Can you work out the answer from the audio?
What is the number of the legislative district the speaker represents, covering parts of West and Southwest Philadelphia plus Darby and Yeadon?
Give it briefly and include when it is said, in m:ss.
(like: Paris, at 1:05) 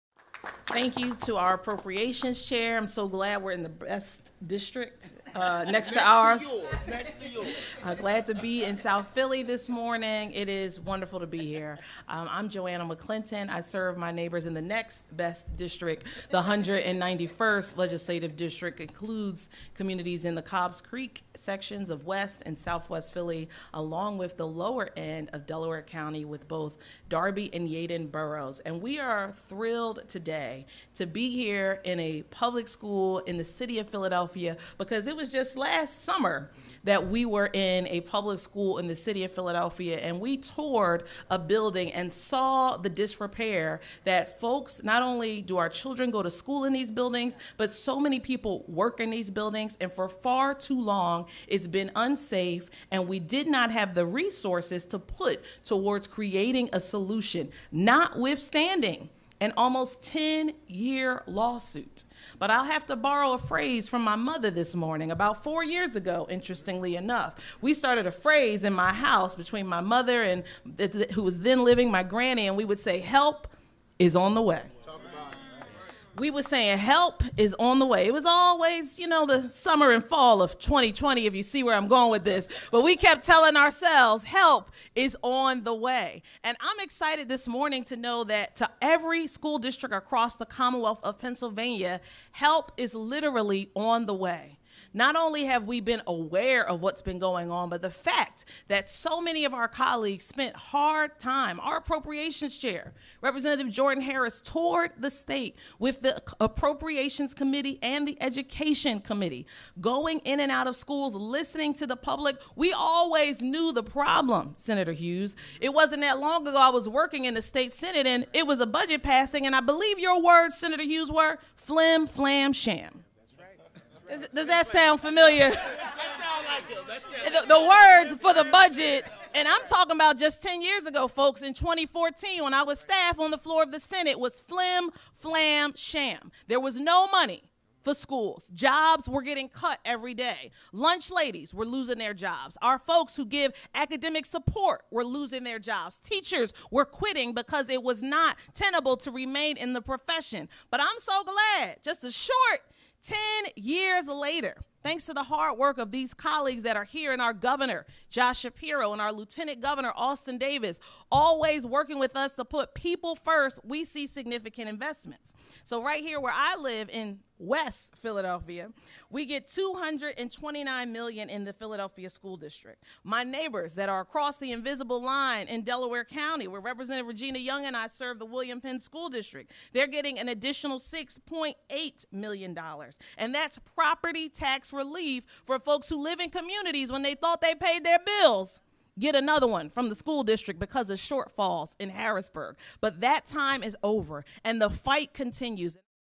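191st, at 0:16.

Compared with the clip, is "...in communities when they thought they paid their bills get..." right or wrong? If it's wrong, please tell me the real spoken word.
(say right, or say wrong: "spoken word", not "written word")
right.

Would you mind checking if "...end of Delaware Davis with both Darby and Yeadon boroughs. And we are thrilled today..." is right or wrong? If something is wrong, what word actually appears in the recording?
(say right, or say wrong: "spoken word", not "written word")
wrong: "County", not "Davis".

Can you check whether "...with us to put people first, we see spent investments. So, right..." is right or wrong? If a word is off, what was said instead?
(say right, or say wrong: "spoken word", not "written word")
wrong: "significant", not "spent".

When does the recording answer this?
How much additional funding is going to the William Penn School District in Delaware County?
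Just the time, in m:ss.
3:00.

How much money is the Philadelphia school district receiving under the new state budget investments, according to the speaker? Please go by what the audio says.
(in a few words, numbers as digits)
$229 million.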